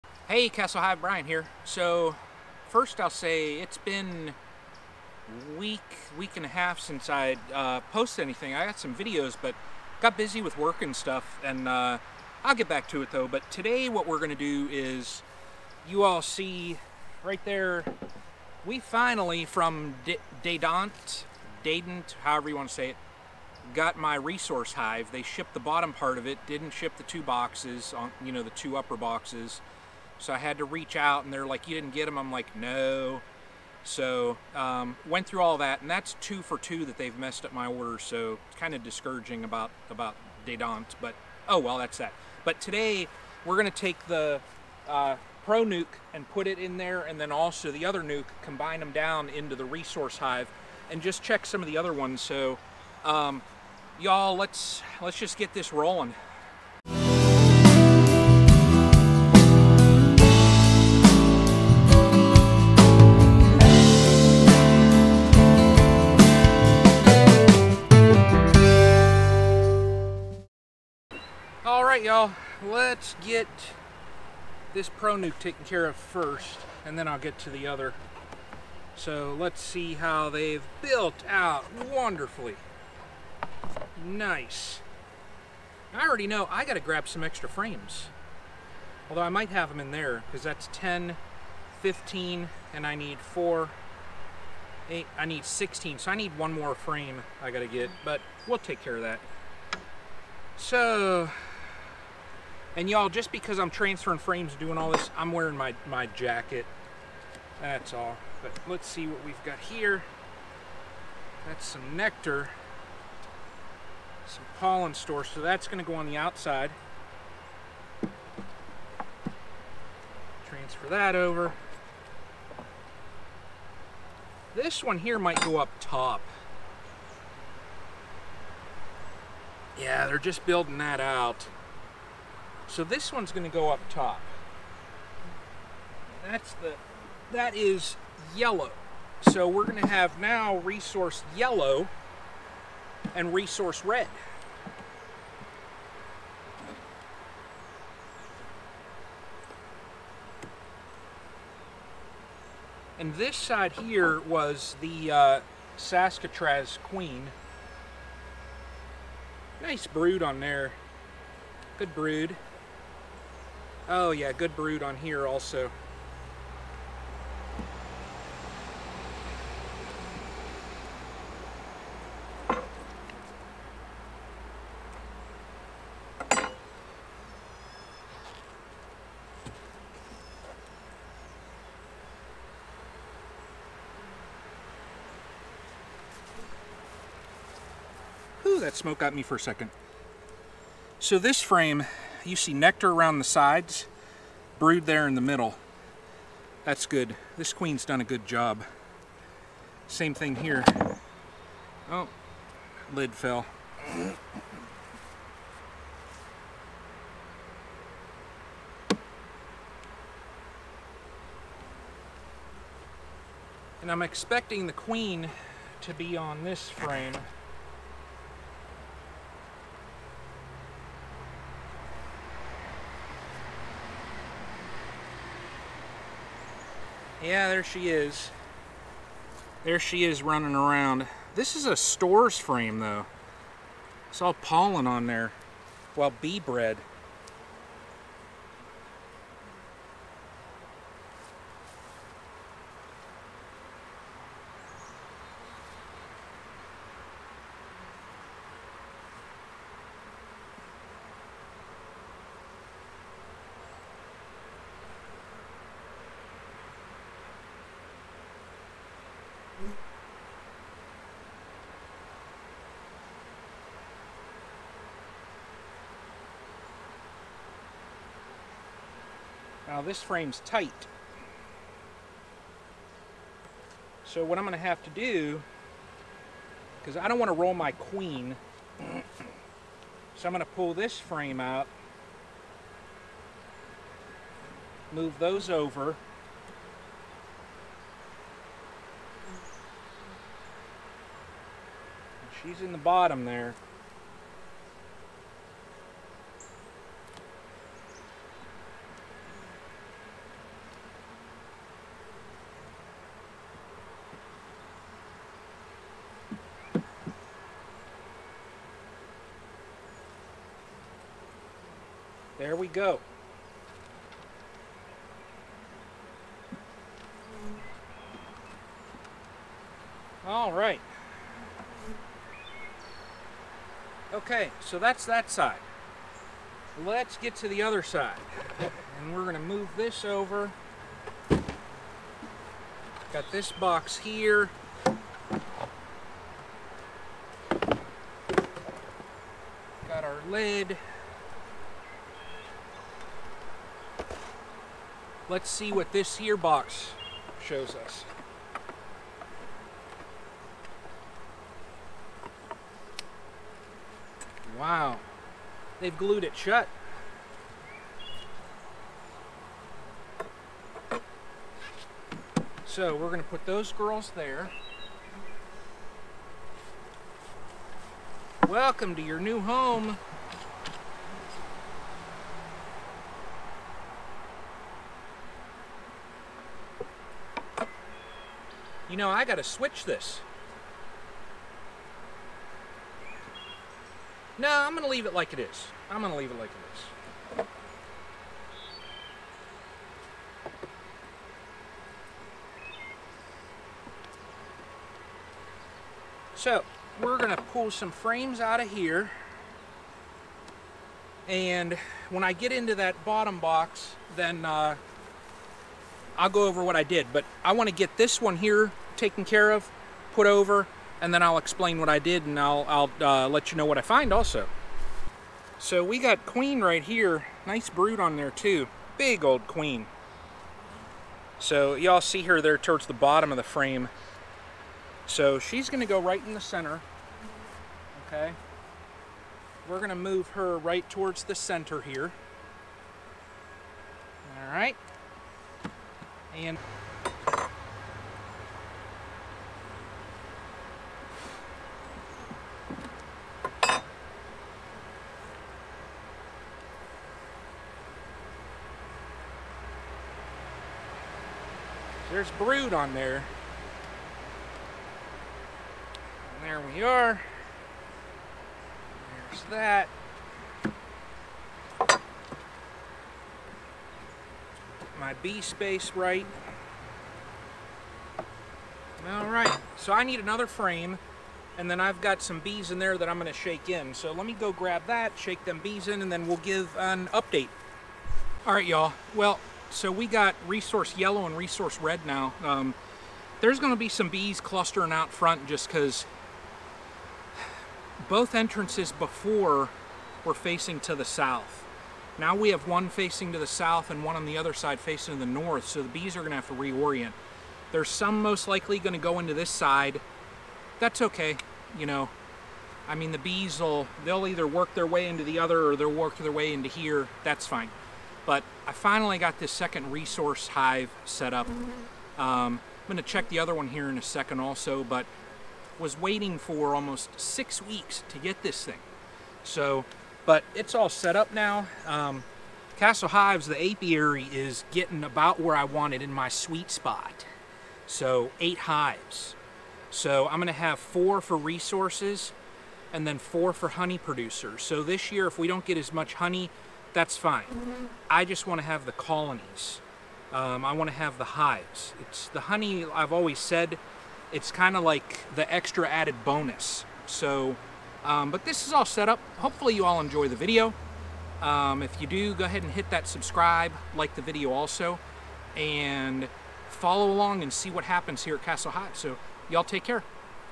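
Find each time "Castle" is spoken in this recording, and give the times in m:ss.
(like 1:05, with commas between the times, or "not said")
0:00, 8:42, 9:18.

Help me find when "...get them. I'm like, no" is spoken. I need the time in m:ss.
0:31.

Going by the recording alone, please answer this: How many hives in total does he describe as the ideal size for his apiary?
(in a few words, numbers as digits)
8.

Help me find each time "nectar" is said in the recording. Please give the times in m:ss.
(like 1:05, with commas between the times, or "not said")
1:51, 3:12.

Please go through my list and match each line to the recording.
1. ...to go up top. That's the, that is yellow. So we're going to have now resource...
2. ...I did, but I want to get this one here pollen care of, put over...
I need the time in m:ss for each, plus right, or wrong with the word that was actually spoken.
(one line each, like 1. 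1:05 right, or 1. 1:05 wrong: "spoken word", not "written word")
1. 2:13 right
2. 6:46 wrong: "taken", not "pollen".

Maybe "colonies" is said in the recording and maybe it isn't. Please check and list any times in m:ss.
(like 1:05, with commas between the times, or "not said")
8:58.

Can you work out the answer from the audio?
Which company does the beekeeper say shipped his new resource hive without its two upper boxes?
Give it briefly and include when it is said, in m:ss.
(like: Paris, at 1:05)
Dadant, at 0:20.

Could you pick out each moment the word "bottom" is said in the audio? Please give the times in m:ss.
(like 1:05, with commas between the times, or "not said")
0:25, 4:52, 6:43, 7:02.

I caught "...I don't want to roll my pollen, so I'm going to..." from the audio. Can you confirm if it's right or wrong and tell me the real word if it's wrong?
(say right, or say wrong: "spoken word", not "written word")
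wrong: "queen", not "pollen".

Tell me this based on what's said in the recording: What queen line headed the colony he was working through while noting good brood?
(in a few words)
Saskatraz.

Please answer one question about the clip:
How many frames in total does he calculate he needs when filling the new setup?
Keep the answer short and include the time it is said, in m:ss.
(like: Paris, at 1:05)
16, at 1:35.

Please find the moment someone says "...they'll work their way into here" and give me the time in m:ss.
8:25.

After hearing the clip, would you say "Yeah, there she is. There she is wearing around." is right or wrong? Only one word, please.
wrong.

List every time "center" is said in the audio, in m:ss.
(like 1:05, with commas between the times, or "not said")
7:06, 7:11.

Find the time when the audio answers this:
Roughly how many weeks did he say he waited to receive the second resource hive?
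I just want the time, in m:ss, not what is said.
8:37.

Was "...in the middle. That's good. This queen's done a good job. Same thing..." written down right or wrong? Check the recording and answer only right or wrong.
right.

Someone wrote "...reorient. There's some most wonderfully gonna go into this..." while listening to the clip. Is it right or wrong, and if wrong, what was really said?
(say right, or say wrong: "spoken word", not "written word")
wrong: "likely", not "wonderfully".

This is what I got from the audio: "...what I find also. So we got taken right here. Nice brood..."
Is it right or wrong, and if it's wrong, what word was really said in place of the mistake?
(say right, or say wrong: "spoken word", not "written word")
wrong: "queen", not "taken".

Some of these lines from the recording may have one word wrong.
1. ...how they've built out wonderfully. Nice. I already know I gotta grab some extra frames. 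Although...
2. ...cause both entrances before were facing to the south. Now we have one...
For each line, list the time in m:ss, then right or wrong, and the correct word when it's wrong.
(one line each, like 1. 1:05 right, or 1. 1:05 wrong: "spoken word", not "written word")
1. 1:19 right
2. 8:05 right.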